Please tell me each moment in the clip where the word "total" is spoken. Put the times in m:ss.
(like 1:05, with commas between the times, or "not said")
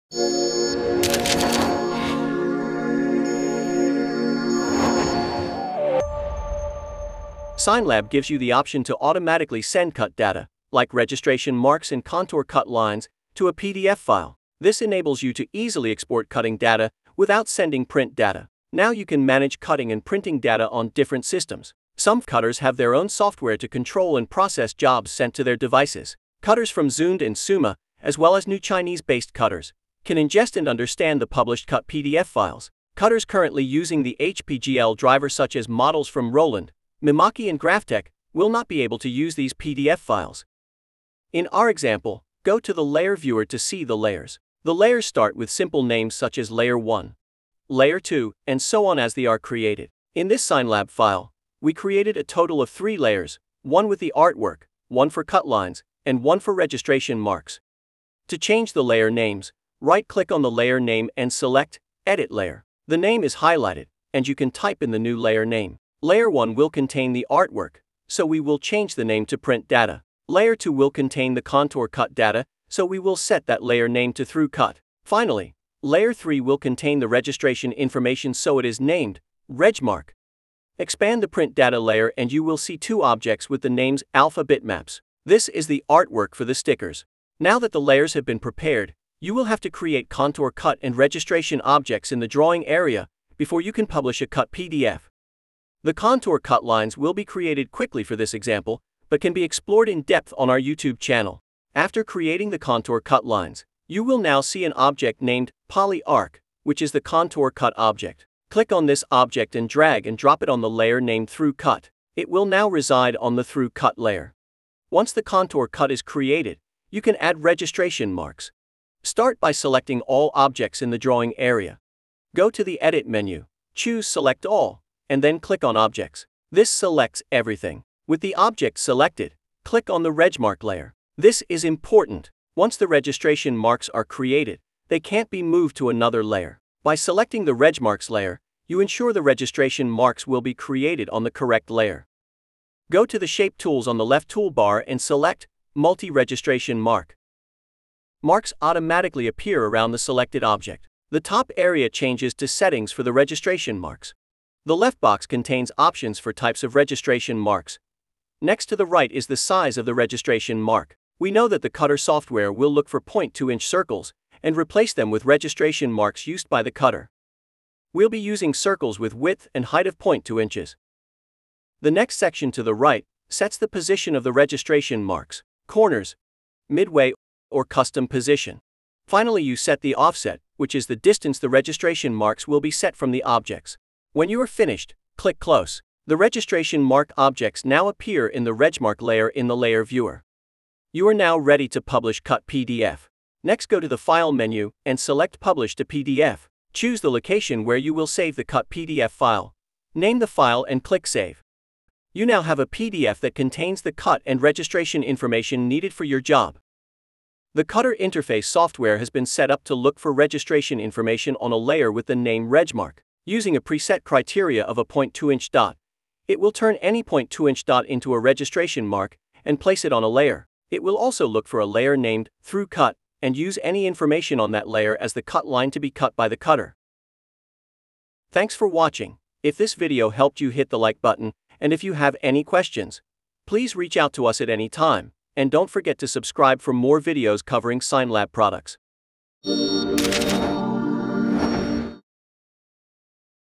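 0:52.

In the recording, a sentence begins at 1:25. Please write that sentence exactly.
This is the artwork for the stickers.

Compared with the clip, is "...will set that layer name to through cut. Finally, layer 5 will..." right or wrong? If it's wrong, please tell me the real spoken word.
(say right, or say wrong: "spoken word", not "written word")
wrong: "3", not "5".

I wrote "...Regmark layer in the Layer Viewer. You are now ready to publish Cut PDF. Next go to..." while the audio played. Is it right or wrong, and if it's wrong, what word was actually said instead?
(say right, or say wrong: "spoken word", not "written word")
right.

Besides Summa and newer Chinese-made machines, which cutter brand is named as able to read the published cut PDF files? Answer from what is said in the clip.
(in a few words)
Zund.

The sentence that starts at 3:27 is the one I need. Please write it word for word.
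The Cutter interface software has been set up to look for registration information on a layer with the name regmark.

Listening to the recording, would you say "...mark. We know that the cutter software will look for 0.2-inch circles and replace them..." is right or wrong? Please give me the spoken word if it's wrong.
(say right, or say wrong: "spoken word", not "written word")
right.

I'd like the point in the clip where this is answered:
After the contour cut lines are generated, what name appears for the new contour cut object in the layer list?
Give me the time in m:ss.
1:45.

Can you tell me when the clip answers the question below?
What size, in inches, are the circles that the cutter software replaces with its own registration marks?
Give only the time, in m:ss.
2:49.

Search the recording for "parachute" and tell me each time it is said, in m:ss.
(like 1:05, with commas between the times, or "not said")
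not said.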